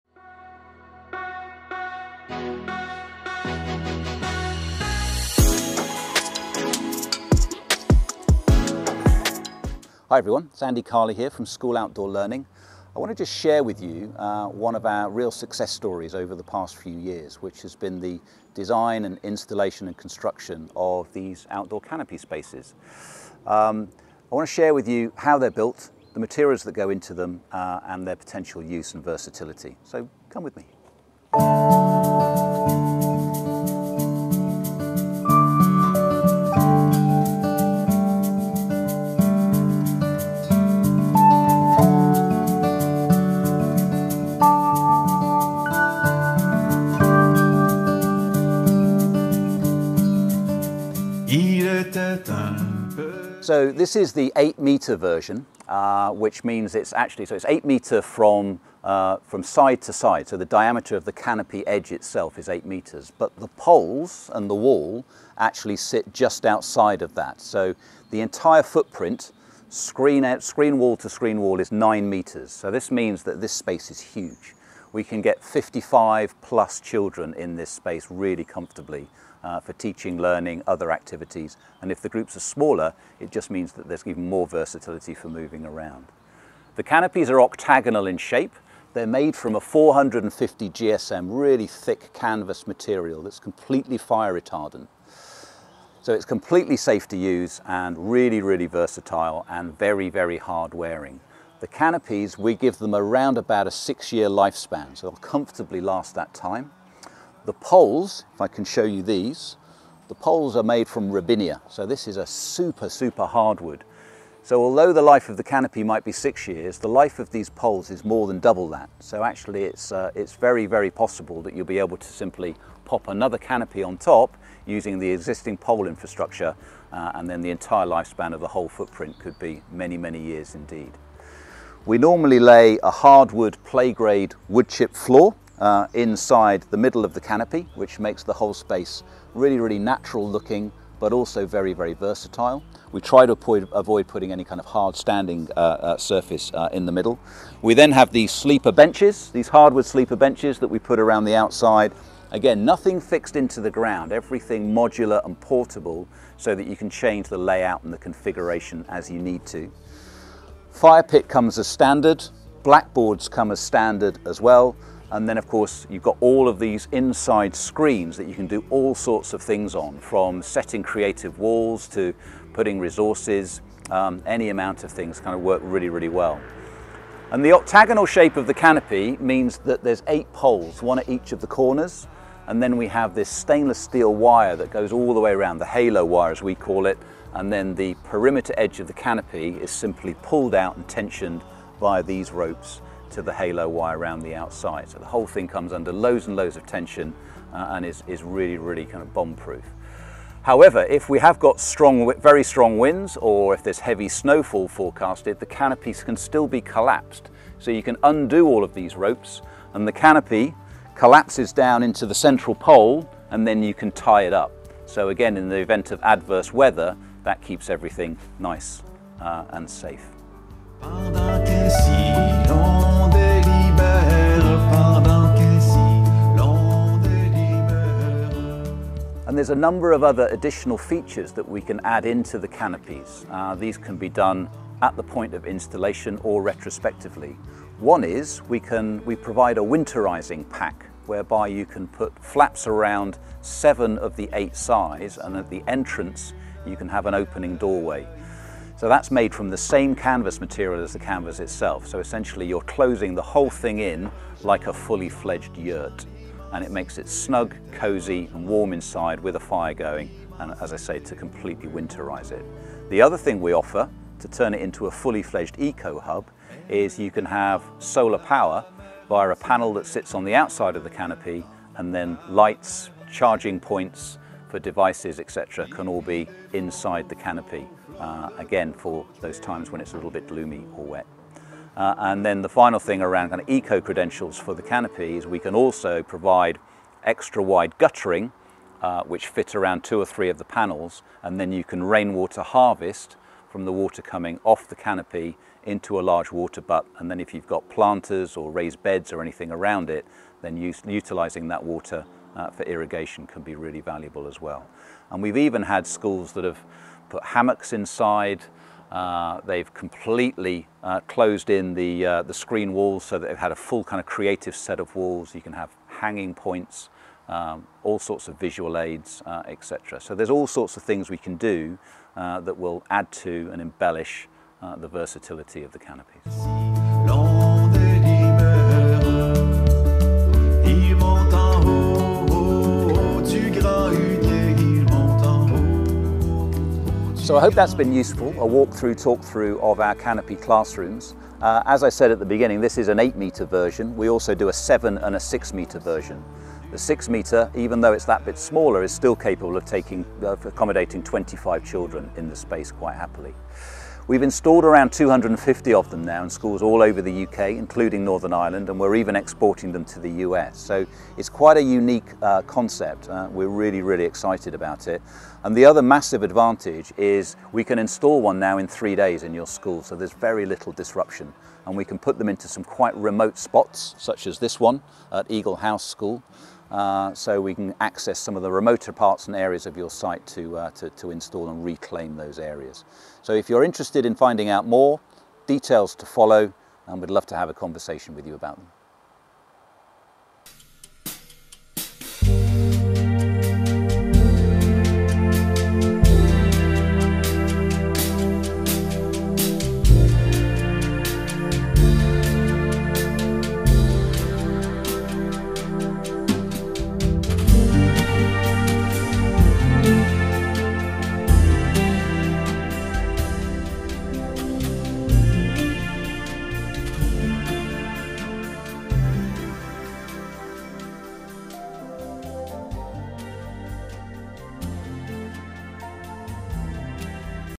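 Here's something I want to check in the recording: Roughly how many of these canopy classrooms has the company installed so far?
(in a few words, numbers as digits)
250.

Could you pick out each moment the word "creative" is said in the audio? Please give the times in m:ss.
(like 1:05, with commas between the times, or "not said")
2:50, 5:14.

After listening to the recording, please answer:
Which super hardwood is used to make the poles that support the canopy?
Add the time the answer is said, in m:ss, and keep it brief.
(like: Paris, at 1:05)
Robinia, at 1:51.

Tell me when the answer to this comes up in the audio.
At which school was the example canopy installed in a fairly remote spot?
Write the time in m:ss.
6:15.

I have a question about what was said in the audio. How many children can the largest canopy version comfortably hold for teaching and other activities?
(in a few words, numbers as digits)
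55.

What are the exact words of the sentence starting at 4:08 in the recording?
So that's made from the same canvas material as the canvas itself.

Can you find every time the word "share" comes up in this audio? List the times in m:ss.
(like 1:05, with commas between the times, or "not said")
0:13, 0:24.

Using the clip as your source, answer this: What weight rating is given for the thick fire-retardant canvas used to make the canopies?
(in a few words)
450 GSM.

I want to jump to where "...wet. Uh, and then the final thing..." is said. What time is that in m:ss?
4:40.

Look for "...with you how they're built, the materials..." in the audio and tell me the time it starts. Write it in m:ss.
0:24.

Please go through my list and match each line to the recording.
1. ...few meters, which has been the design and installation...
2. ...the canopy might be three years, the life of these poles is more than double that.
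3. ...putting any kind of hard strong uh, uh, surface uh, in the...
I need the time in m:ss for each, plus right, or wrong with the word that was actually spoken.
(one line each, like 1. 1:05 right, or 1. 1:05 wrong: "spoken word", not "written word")
1. 0:16 wrong: "years", not "meters"
2. 1:55 wrong: "six", not "three"
3. 2:24 wrong: "standing", not "strong".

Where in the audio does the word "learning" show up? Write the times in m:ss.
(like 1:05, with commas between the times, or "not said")
0:12, 1:20.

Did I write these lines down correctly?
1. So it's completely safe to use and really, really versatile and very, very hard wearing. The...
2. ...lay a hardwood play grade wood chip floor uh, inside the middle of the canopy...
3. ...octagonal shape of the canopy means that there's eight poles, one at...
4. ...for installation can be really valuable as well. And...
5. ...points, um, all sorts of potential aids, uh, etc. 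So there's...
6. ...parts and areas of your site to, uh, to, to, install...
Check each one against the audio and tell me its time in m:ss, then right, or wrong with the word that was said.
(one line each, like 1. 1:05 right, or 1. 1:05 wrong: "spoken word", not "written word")
1. 1:36 right
2. 2:12 right
3. 2:57 right
4. 5:02 wrong: "irrigation", not "installation"
5. 5:16 wrong: "visual", not "potential"
6. 6:18 right.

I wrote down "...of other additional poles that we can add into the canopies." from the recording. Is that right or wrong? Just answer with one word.
wrong.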